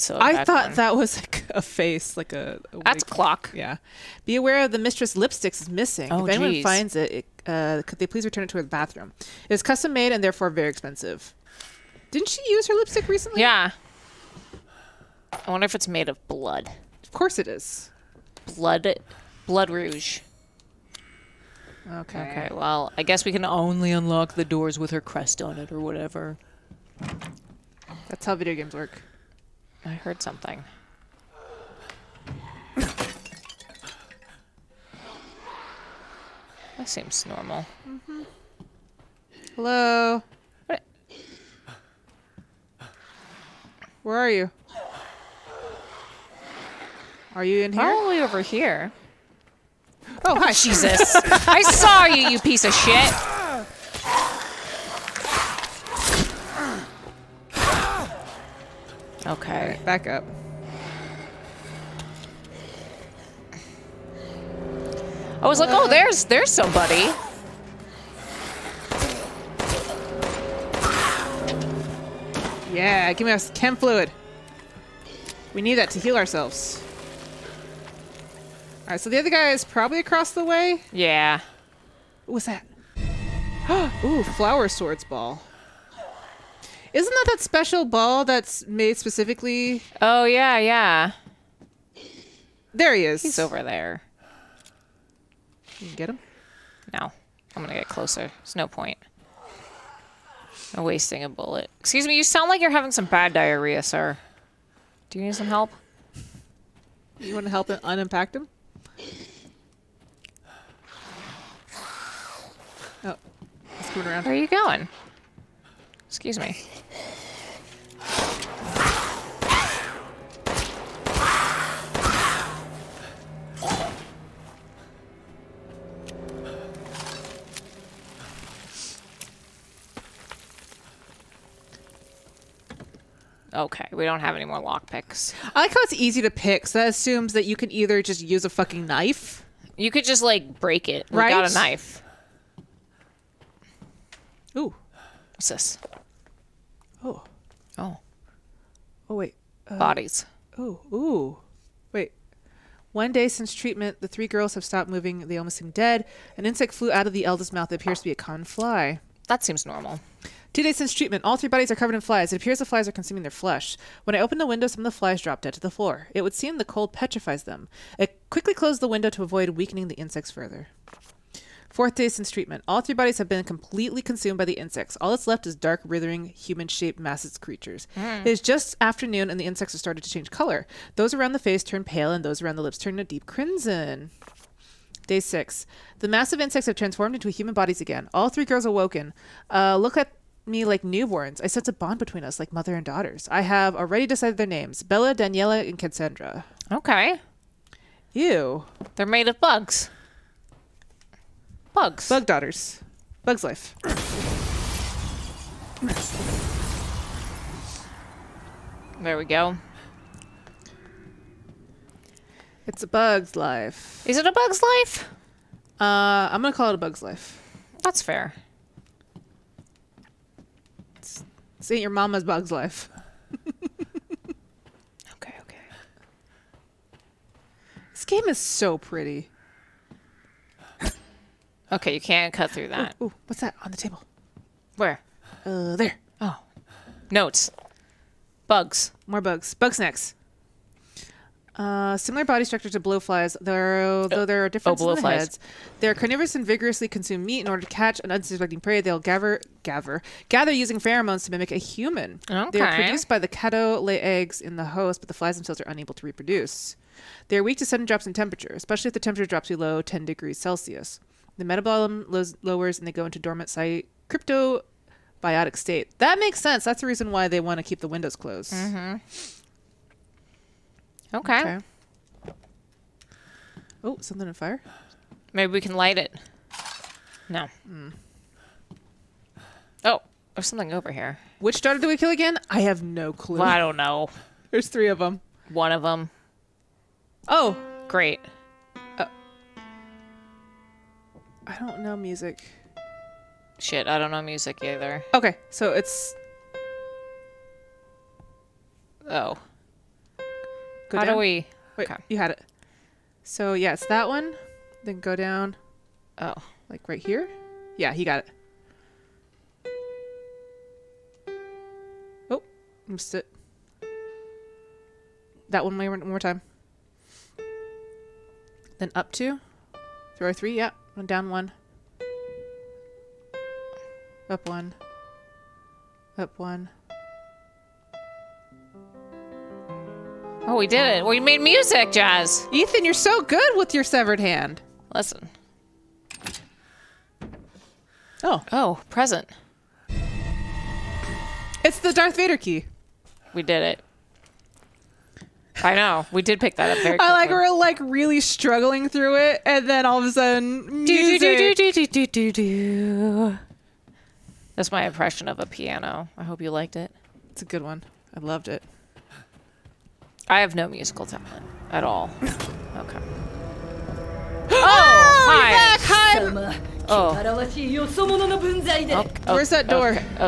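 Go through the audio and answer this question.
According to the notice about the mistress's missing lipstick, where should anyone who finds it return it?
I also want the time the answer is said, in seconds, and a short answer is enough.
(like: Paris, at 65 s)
Her bathroom, at 8 s.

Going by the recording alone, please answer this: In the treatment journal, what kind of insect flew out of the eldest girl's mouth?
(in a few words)
A common fly.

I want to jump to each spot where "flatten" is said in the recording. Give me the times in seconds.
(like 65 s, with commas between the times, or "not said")
not said.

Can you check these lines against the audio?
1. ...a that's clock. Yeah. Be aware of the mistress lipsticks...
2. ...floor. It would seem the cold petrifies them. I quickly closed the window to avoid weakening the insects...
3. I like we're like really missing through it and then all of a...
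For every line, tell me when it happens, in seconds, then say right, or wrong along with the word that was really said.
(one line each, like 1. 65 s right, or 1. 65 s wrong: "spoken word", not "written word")
1. 2 s right
2. 165 s right
3. 347 s wrong: "struggling", not "missing".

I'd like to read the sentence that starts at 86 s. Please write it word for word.
Isn't that that special ball that's made specifically?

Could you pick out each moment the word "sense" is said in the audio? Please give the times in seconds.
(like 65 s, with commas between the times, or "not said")
191 s, 266 s.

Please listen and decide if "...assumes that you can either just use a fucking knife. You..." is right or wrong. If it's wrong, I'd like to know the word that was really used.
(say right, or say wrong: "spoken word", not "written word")
right.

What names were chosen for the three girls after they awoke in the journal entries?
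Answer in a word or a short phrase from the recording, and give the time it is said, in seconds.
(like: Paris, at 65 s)
Bella, Daniela, and Cassandra, at 194 s.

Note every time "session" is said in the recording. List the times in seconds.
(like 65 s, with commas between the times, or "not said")
not said.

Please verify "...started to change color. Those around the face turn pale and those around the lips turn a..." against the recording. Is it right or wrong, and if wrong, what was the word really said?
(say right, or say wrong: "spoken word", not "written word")
right.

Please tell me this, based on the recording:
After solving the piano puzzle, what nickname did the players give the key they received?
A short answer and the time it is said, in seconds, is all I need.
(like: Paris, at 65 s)
Darth Vader key, at 341 s.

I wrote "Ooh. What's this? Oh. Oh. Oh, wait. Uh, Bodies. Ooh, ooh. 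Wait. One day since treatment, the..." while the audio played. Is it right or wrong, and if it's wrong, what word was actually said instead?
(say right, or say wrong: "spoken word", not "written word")
right.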